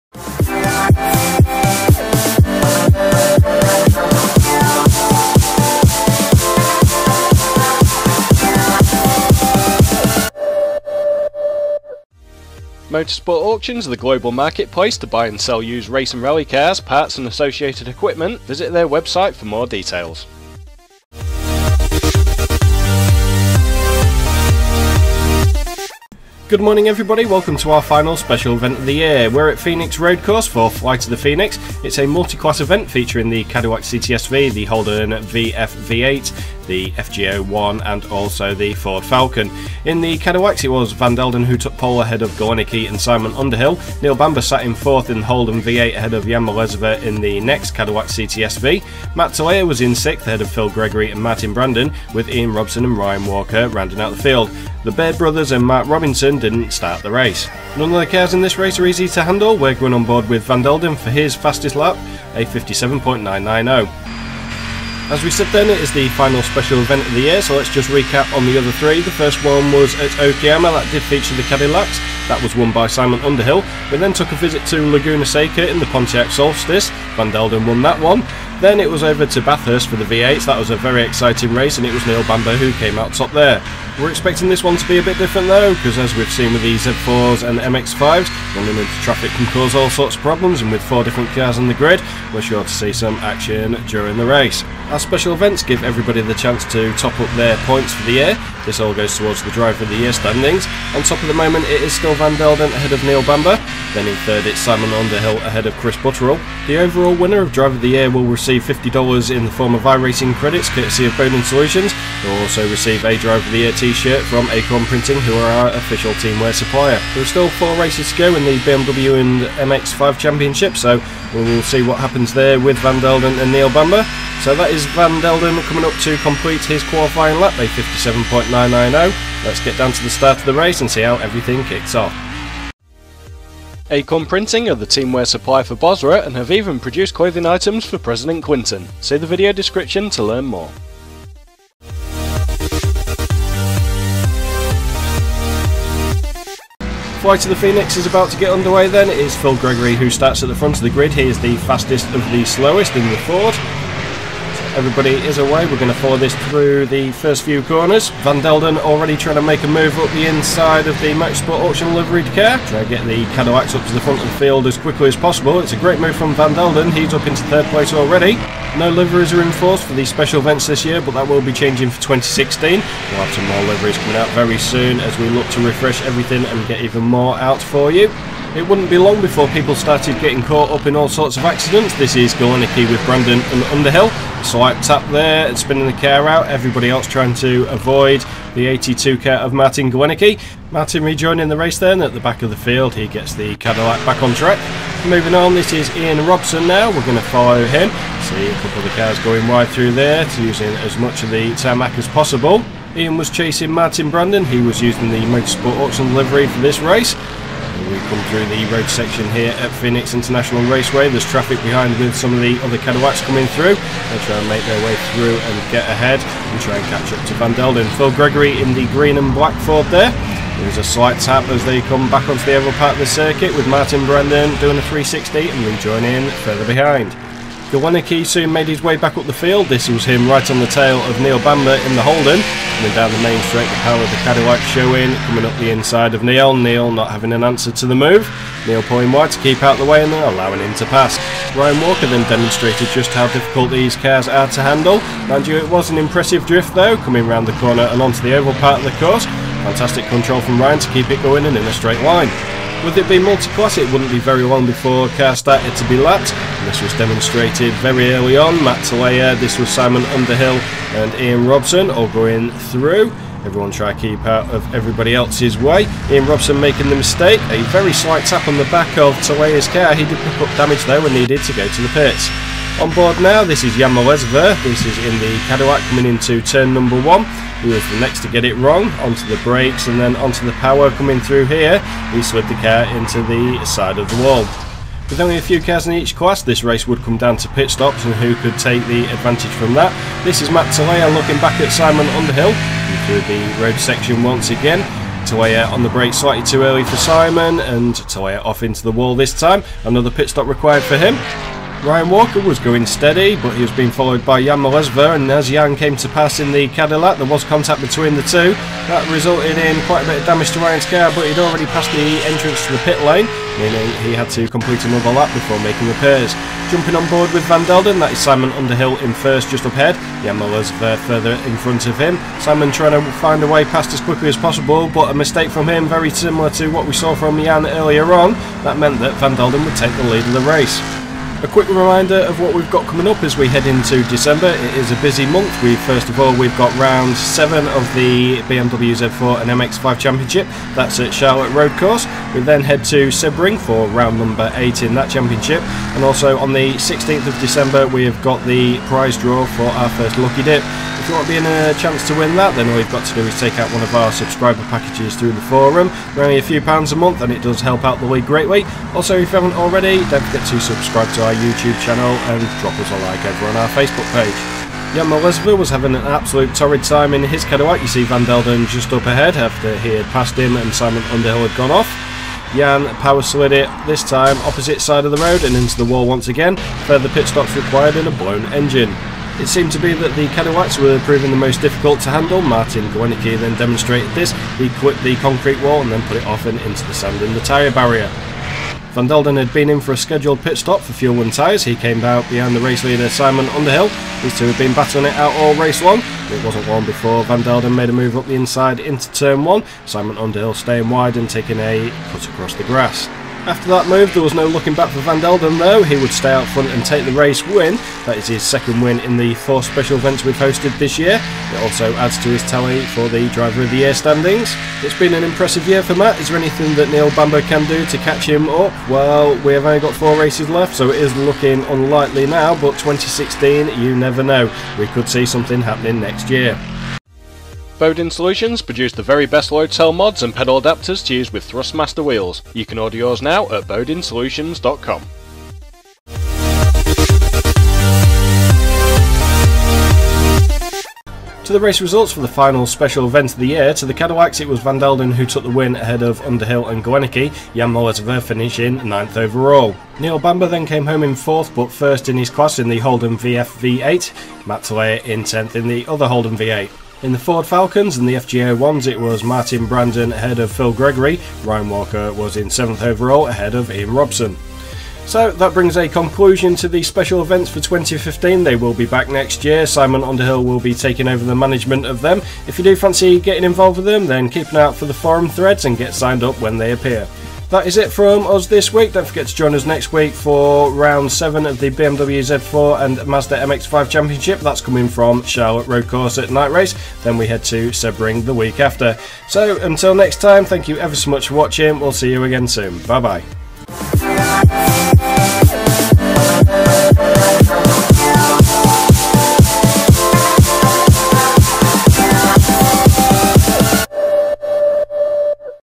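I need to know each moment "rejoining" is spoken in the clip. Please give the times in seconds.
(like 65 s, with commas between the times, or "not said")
191 s, 225 s.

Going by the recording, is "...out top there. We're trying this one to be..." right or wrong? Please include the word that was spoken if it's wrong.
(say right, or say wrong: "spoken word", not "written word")
wrong: "expecting", not "trying".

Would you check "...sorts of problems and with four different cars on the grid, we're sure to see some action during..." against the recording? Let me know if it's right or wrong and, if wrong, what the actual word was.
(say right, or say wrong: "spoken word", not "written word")
right.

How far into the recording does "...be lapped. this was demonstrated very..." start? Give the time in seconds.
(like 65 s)
255 s.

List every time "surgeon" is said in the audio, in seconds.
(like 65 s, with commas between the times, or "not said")
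not said.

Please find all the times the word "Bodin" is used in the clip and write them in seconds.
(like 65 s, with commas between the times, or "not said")
111 s, 427 s.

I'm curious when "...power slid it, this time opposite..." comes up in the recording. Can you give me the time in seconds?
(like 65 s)
373 s.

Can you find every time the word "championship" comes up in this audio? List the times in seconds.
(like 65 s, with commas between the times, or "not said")
120 s, 339 s, 345 s, 483 s.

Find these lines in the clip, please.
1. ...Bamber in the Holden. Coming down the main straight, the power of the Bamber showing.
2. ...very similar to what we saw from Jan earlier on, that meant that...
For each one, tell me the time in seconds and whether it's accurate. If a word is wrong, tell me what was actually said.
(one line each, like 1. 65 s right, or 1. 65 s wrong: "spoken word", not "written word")
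1. 231 s wrong: "Cadillac", not "Bamber"
2. 325 s right.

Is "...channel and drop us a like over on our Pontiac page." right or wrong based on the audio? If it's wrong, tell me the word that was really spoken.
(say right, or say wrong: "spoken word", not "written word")
wrong: "Facebook", not "Pontiac".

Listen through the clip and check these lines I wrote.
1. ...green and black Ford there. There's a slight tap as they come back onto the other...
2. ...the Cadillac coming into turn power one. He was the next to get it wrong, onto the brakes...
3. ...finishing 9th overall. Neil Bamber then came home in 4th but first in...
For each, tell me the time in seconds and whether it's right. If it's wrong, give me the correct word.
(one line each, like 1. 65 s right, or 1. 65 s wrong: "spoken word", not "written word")
1. 218 s right
2. 275 s wrong: "number", not "power"
3. 448 s right.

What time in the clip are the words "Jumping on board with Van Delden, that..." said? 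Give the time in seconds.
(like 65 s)
316 s.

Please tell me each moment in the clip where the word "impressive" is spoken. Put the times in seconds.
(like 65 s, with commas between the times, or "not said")
245 s, 415 s.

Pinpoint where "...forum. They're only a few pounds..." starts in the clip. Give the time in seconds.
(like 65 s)
355 s.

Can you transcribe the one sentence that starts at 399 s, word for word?
Simon Underhill staying wide and taking a cut across the grass.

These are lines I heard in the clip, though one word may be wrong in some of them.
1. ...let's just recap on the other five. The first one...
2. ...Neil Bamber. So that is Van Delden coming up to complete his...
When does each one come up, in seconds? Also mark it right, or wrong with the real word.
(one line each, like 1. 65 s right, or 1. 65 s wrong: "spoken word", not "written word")
1. 67 s wrong: "three", not "five"
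2. 123 s right.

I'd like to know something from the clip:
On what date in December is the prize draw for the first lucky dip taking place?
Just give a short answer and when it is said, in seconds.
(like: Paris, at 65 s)
16th of December, at 346 s.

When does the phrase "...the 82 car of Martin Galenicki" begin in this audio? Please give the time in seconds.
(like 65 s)
188 s.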